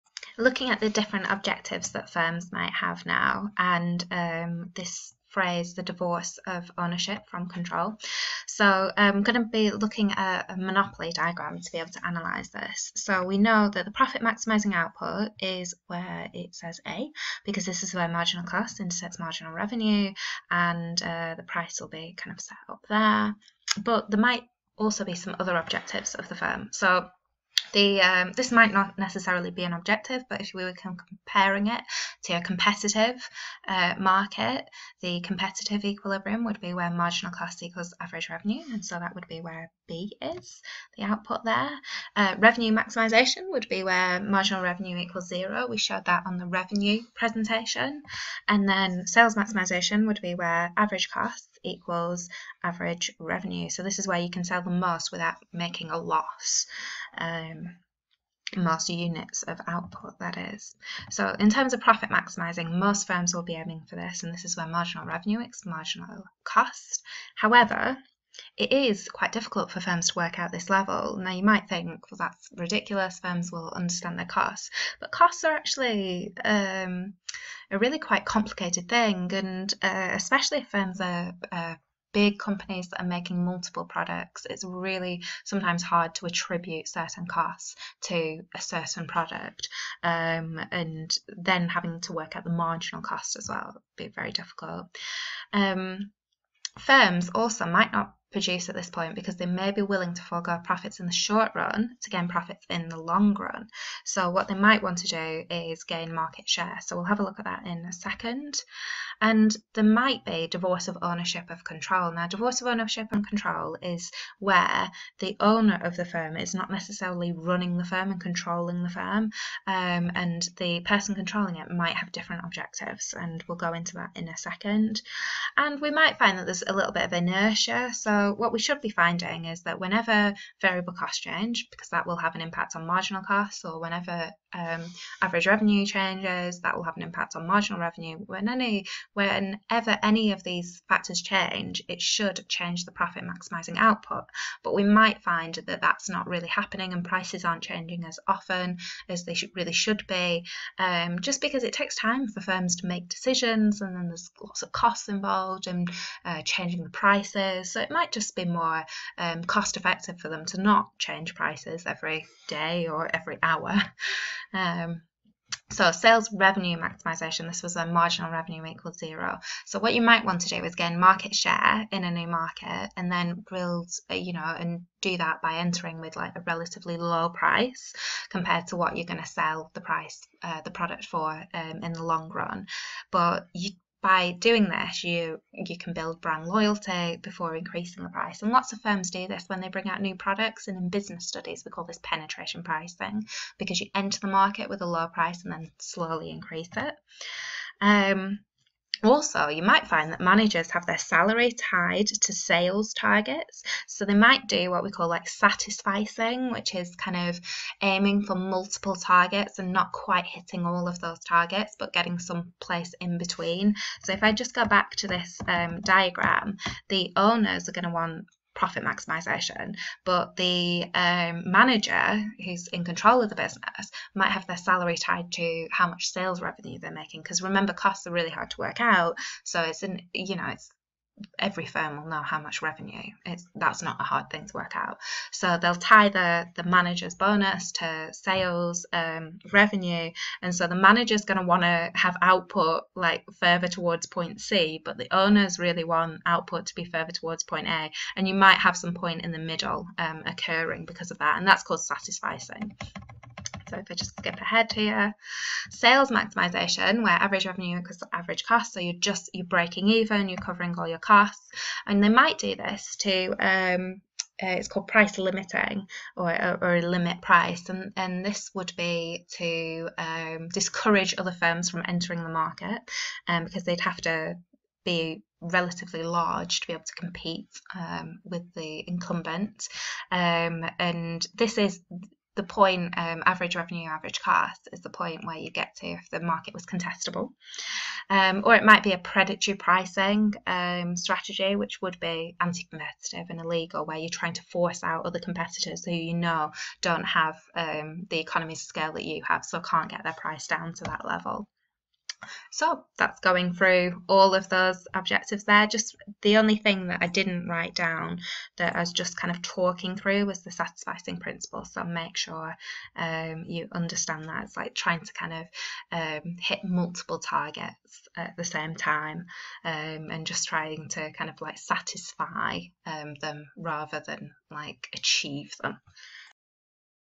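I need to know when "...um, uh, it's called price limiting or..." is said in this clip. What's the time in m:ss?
4:23.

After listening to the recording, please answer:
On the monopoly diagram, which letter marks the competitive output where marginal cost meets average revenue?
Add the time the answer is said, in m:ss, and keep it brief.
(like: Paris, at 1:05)
B, at 0:39.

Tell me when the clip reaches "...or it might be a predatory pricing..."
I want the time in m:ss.
4:48.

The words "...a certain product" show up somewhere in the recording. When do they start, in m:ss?
1:28.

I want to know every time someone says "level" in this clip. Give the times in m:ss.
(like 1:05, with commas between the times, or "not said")
1:10, 5:01.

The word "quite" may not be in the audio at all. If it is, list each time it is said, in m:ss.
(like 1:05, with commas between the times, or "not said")
1:09, 1:17, 3:29.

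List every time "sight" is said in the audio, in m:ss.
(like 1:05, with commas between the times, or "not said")
not said.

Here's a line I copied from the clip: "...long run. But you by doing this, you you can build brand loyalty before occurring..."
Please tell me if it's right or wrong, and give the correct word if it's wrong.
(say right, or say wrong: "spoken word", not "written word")
wrong: "increasing", not "occurring".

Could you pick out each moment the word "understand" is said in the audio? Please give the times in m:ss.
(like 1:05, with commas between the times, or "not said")
1:13, 5:13.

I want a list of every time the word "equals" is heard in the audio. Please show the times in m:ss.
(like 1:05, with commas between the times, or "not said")
0:37, 0:44, 0:51, 2:48, 4:17.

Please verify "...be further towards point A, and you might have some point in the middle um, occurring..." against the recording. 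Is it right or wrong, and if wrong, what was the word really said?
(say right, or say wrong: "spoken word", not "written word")
right.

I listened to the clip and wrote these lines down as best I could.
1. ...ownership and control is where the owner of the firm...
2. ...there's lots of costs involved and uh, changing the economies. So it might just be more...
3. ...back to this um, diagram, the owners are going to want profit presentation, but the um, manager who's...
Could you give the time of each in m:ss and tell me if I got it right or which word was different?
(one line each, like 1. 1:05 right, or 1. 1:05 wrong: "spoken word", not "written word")
1. 1:52 right
2. 2:34 wrong: "prices", not "economies"
3. 3:34 wrong: "maximization", not "presentation".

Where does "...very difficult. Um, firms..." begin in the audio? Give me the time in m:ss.
1:34.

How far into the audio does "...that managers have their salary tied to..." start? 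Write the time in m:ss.
3:20.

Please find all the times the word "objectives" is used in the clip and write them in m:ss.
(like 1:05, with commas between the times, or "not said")
0:01, 0:25, 0:29, 2:02, 5:04.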